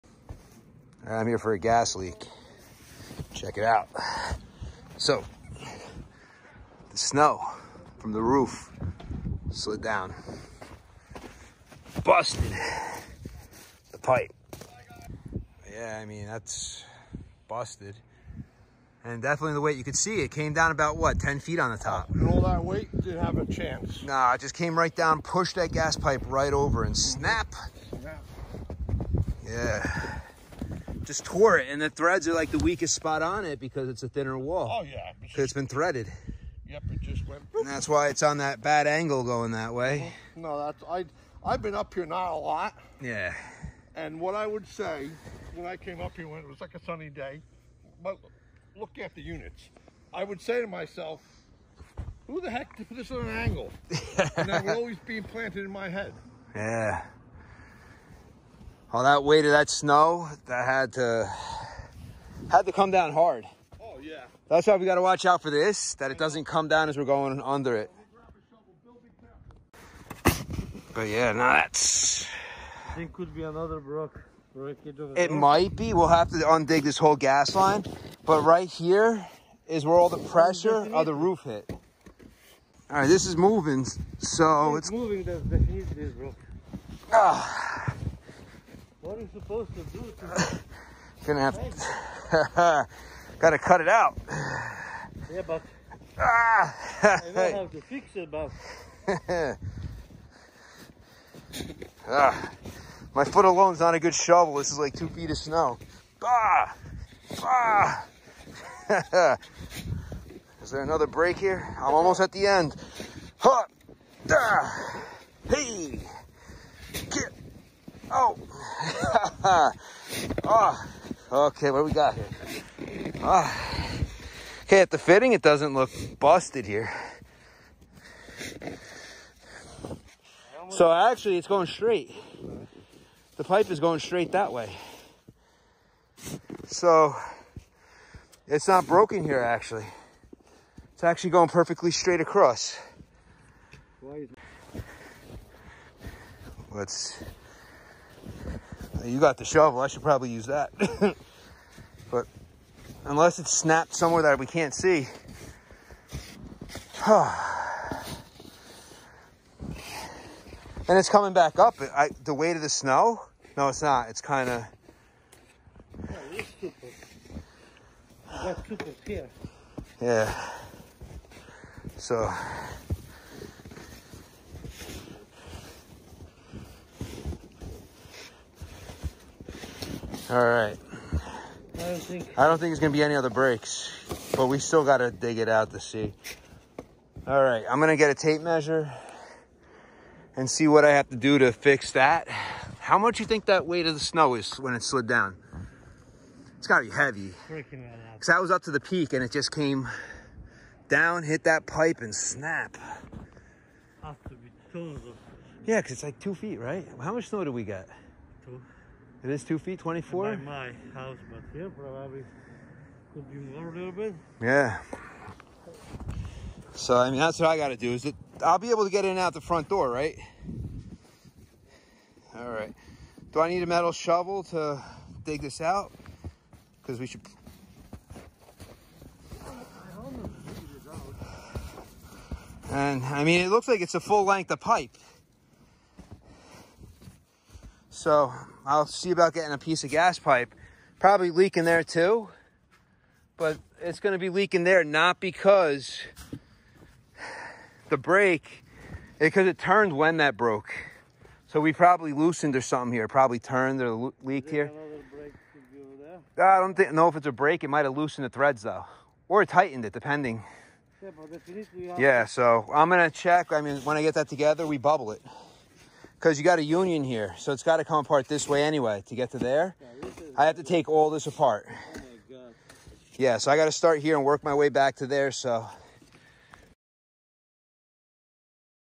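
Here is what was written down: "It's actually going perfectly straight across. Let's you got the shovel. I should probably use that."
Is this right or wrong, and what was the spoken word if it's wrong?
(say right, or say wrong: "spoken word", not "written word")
right.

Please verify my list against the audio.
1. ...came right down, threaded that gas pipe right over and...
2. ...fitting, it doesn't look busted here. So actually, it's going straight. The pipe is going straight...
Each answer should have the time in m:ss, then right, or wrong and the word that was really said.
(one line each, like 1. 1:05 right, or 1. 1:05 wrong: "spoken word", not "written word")
1. 0:24 wrong: "pushed", not "threaded"
2. 2:04 right.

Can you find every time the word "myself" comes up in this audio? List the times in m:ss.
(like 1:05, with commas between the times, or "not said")
0:50.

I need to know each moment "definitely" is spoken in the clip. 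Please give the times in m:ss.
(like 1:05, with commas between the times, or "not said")
0:19, 1:25.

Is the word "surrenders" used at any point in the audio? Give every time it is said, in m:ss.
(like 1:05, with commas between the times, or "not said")
not said.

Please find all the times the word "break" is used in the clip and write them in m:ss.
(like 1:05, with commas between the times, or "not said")
1:51, 3:03, 4:07, 4:17.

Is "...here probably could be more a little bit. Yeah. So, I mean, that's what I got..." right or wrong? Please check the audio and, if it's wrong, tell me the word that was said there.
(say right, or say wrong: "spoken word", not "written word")
right.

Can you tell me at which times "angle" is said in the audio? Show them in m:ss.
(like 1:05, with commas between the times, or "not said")
0:38, 0:53.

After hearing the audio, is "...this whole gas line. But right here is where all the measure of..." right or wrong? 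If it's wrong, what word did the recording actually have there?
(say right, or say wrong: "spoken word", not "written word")
wrong: "pressure", not "measure".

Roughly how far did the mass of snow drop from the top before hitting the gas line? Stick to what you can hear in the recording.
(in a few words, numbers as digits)
10 feet.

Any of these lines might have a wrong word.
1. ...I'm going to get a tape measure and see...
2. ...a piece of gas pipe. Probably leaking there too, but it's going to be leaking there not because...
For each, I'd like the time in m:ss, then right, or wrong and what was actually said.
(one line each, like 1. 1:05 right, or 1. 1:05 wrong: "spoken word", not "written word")
1. 3:07 right
2. 3:59 right.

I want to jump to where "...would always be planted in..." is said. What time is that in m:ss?
0:54.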